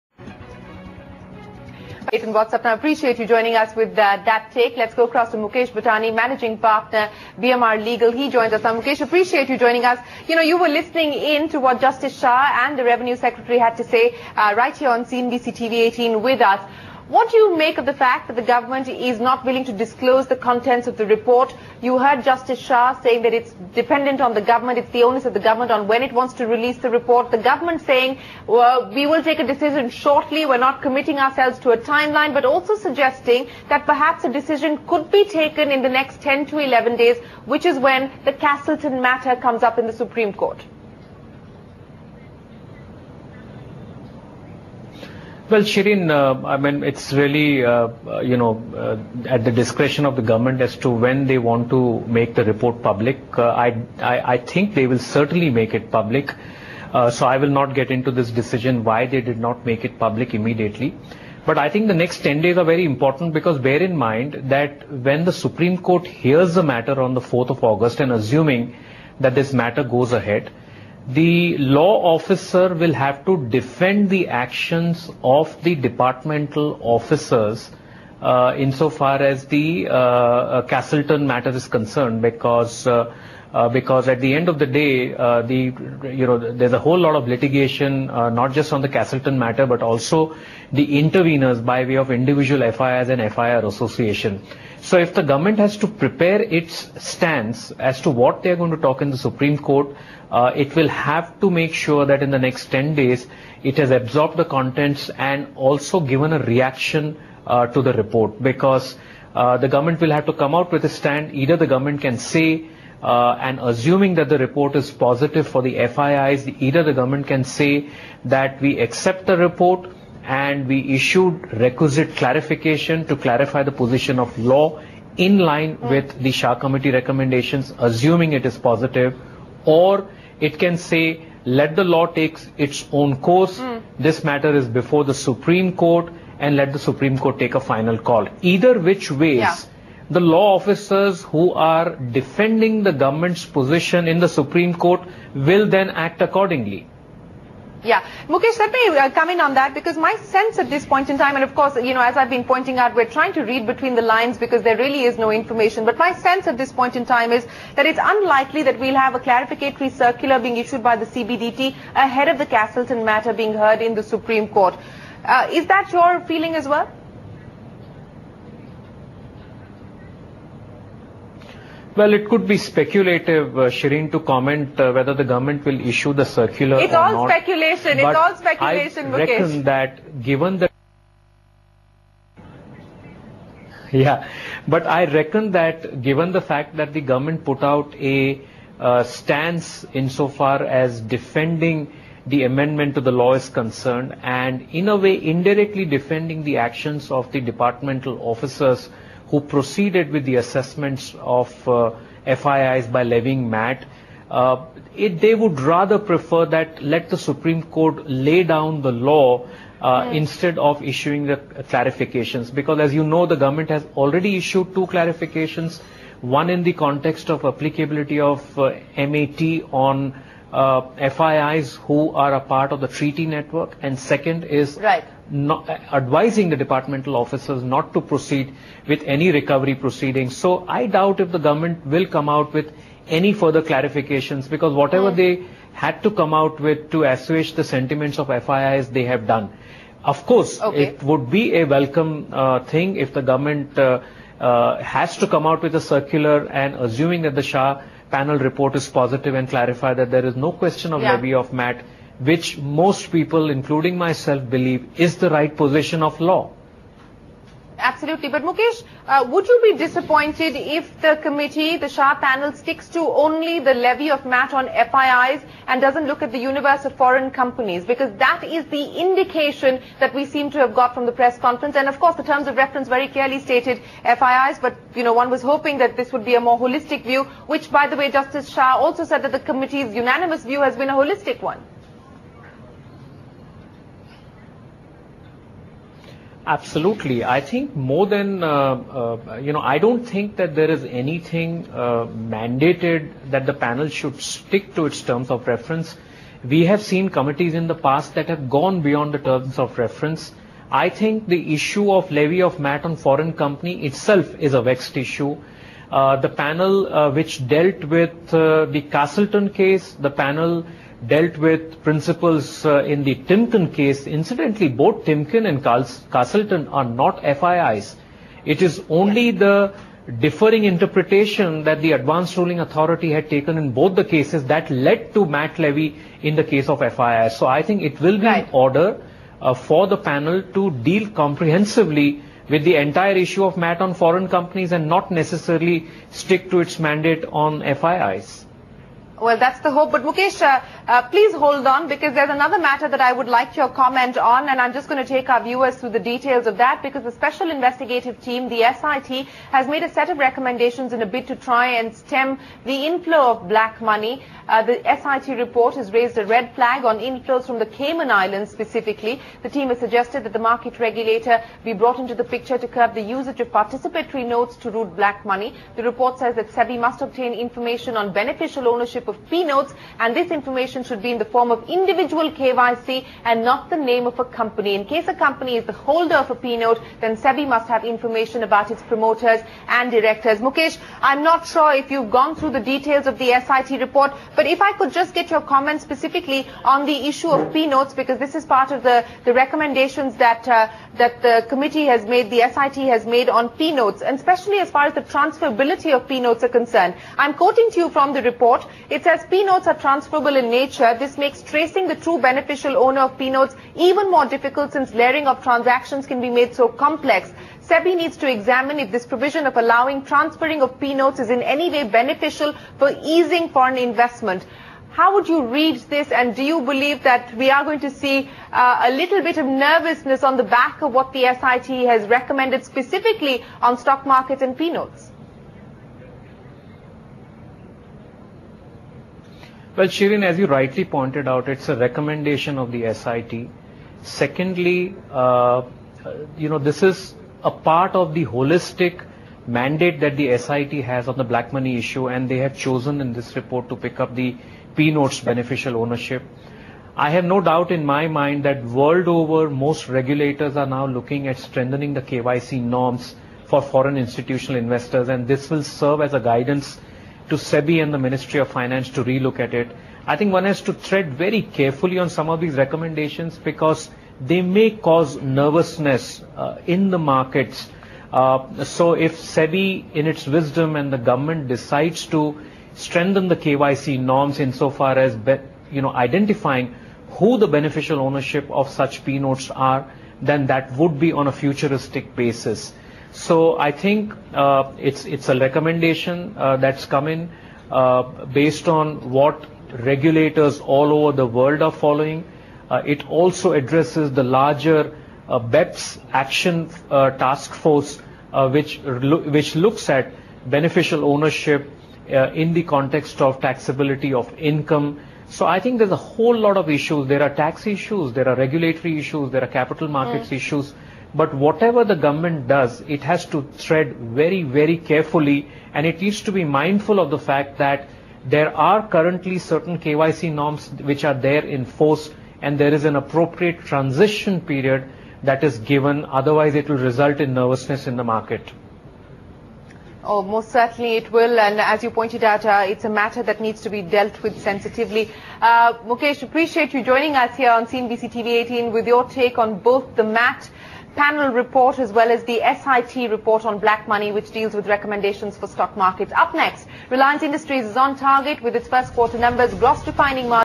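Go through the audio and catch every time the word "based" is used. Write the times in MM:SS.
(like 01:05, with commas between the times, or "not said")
08:08.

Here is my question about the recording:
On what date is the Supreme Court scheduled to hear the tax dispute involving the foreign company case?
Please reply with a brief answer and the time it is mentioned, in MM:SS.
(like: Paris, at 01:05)
4th of August, at 01:07.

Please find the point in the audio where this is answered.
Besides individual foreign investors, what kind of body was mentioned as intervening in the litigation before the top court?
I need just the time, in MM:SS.
01:33.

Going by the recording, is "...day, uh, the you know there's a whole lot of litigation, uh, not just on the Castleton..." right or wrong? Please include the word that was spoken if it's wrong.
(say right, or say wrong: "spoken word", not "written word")
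right.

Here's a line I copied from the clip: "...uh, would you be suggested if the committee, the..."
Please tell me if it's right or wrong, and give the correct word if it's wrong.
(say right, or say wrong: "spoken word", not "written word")
wrong: "disappointed", not "suggested".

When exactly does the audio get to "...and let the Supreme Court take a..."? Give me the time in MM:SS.
02:16.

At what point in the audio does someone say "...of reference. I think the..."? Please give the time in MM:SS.
04:59.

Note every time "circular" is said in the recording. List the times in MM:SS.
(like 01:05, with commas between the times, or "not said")
02:39, 02:56, 04:05.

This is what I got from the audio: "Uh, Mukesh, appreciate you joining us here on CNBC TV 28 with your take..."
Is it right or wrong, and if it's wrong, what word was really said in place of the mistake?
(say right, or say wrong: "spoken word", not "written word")
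wrong: "18", not "28".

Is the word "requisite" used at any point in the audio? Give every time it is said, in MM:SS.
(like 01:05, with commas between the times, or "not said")
02:01.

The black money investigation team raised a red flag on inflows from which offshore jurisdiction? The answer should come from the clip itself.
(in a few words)
Cayman Islands.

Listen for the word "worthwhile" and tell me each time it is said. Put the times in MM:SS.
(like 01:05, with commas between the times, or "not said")
not said.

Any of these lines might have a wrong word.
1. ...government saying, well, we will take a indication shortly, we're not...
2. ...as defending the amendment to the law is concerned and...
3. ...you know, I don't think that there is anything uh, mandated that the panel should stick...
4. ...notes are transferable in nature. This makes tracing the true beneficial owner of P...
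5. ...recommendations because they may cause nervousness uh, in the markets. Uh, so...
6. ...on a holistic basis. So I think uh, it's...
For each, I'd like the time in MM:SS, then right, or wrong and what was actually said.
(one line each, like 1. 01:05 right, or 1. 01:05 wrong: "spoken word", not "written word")
1. 00:27 wrong: "decision", not "indication"
2. 03:10 right
3. 04:49 right
4. 06:39 right
5. 07:42 right
6. 08:01 wrong: "futuristic", not "holistic".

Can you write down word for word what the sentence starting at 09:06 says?
Up next, Reliance Industries is on target with its first quarter numbers, gross refining margin.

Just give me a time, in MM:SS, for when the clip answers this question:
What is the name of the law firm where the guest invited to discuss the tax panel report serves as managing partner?
00:07.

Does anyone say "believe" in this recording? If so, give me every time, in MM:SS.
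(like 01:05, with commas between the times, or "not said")
04:14, 06:56.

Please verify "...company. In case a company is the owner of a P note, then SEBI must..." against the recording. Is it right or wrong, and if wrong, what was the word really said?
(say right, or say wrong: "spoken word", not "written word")
wrong: "holder", not "owner".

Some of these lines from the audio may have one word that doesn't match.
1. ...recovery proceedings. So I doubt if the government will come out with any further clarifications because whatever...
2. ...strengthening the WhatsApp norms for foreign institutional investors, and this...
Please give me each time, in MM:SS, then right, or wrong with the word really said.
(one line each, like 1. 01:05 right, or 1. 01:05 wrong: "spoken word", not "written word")
1. 03:49 right
2. 07:31 wrong: "KYC", not "WhatsApp".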